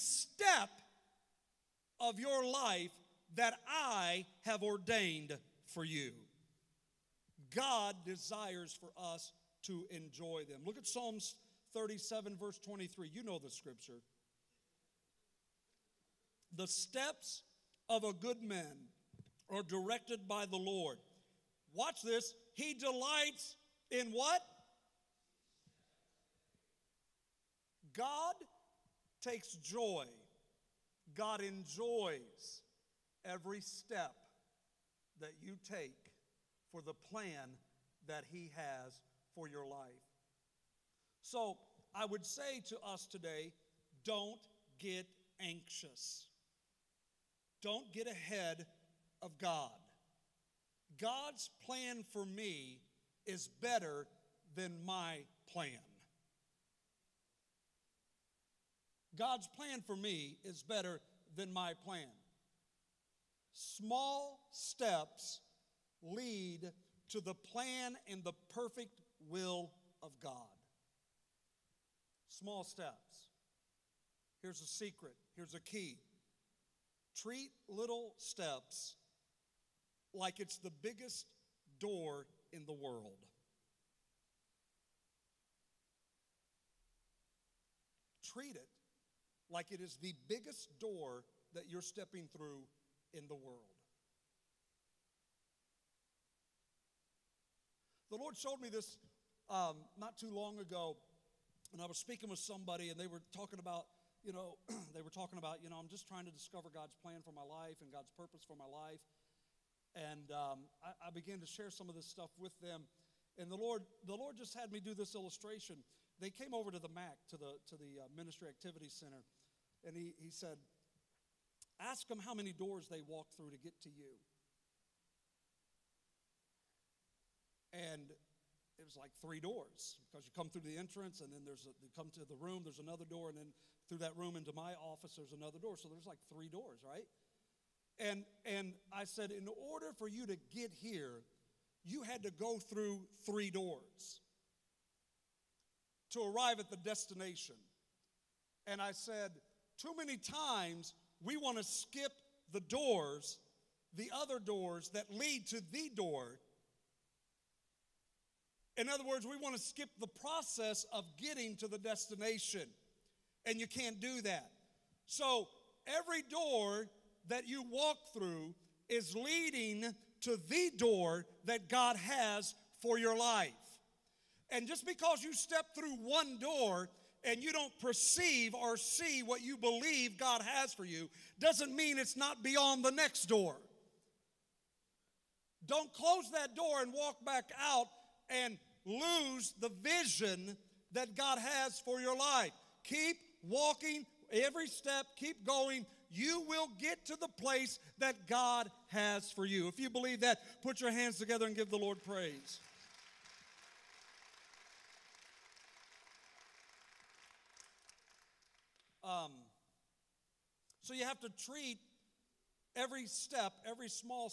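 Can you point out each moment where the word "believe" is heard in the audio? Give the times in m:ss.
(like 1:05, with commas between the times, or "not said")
2:59, 3:19.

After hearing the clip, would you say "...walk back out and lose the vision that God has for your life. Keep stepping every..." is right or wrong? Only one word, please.
wrong.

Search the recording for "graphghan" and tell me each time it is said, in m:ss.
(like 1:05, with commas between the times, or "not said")
not said.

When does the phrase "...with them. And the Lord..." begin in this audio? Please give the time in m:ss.
1:52.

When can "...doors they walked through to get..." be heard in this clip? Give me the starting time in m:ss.
2:02.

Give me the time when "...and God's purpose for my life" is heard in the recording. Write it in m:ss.
1:47.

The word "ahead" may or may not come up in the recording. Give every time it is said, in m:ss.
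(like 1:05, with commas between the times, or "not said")
0:48.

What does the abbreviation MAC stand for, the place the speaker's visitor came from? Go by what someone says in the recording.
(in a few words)
Ministry Activity Center.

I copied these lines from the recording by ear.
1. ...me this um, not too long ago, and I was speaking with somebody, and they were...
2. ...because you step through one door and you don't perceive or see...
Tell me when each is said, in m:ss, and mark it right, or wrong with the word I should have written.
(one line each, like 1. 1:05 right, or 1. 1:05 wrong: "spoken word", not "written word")
1. 1:38 right
2. 2:54 right.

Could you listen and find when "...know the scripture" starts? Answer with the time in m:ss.
0:13.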